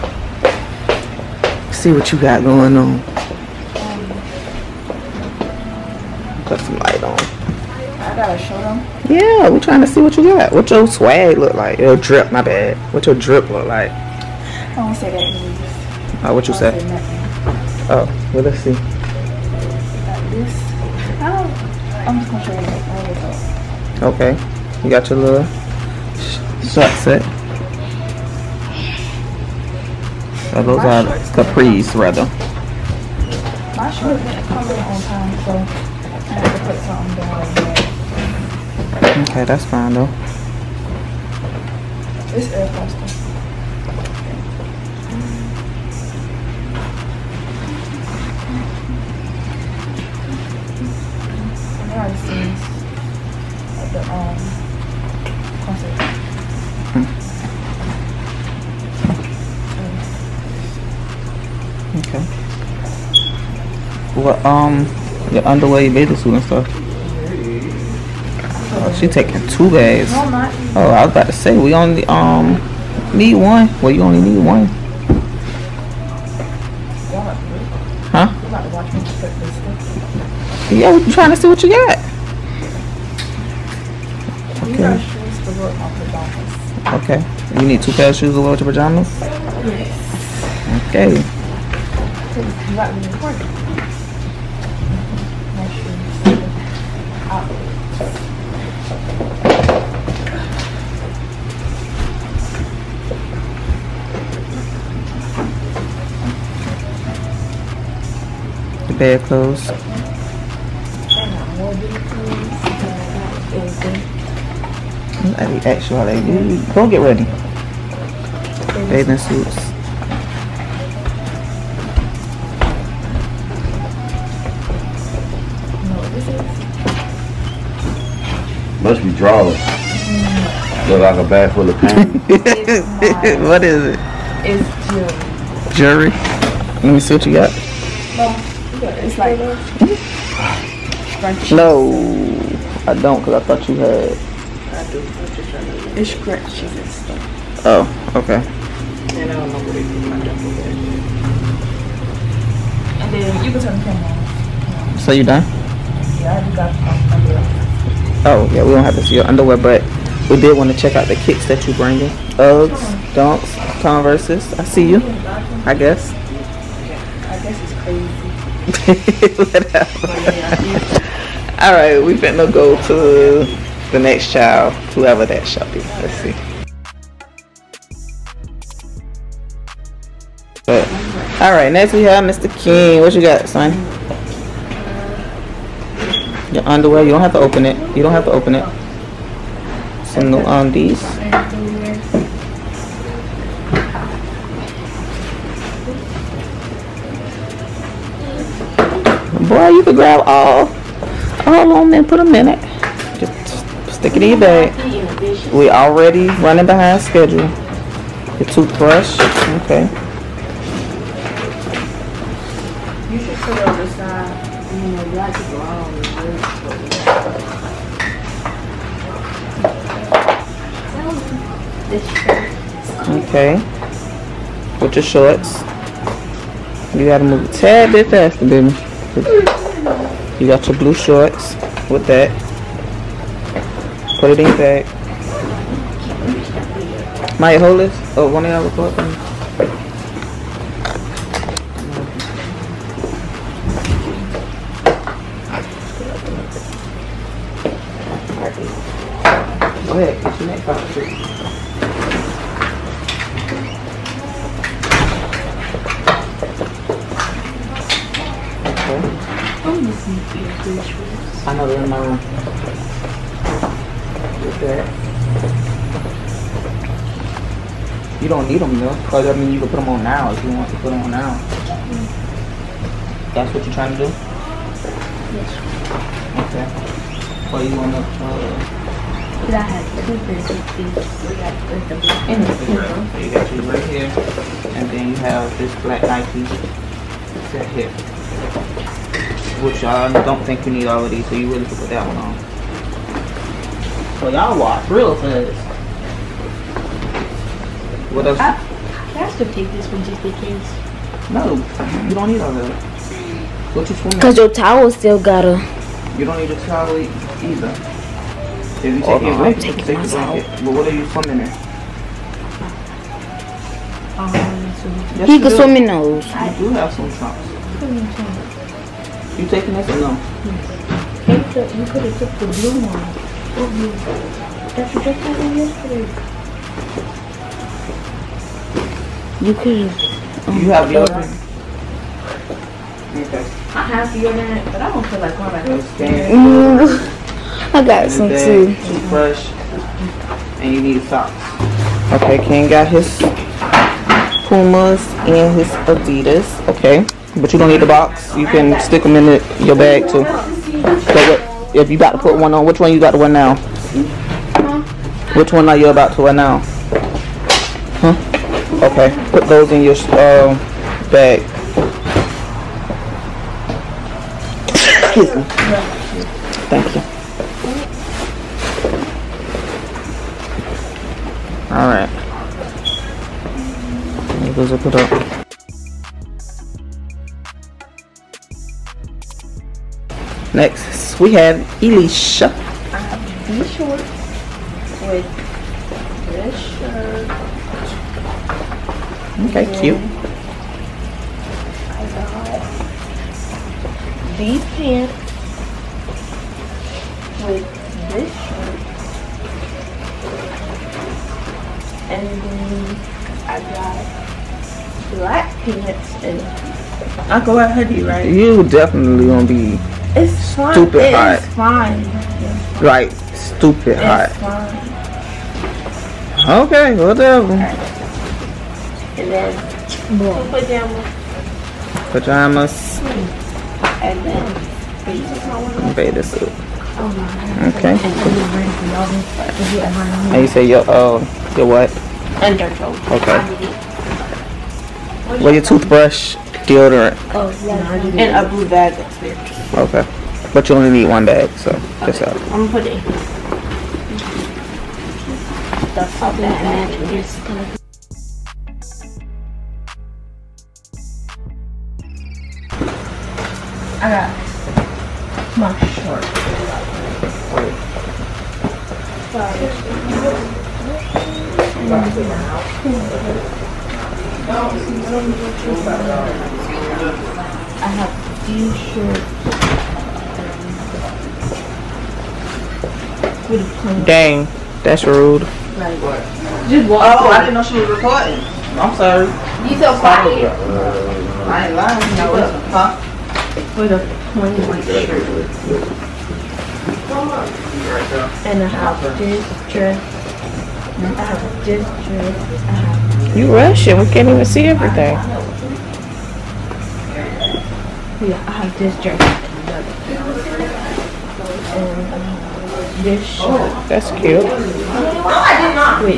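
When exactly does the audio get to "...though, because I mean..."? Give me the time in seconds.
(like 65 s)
268 s.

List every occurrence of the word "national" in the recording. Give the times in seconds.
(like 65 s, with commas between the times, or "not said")
not said.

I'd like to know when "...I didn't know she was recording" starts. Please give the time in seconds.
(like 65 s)
477 s.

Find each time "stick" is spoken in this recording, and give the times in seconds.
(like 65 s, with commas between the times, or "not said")
203 s, 348 s.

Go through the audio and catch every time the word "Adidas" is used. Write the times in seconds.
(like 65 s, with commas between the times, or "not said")
345 s.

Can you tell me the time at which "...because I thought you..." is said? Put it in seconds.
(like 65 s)
143 s.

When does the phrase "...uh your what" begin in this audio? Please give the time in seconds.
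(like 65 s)
430 s.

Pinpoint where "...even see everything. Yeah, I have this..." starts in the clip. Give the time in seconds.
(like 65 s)
494 s.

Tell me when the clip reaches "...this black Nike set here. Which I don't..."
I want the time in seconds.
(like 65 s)
285 s.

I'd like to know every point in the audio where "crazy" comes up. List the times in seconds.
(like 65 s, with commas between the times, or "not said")
169 s.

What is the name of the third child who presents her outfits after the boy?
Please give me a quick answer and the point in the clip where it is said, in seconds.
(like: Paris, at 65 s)
Elicia, at 381 s.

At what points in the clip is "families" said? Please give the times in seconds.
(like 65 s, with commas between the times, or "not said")
not said.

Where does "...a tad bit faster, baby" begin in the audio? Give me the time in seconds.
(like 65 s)
227 s.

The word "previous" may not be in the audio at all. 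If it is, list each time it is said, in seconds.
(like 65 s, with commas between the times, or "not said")
not said.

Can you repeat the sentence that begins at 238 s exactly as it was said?
Oh, one of y'all record for me.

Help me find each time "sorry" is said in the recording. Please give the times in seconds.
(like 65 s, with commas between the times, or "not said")
457 s, 478 s.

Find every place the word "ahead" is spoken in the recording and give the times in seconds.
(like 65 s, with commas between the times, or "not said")
249 s.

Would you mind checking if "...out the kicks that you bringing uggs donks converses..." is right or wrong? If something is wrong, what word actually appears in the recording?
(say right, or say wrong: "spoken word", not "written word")
right.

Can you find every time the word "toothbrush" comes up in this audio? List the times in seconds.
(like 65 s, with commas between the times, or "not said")
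208 s, 338 s, 435 s.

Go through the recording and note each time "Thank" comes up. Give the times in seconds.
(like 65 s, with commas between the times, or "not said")
366 s.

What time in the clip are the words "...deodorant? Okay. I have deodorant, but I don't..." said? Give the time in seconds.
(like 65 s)
330 s.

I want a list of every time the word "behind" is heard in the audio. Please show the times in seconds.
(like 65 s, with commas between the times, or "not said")
206 s.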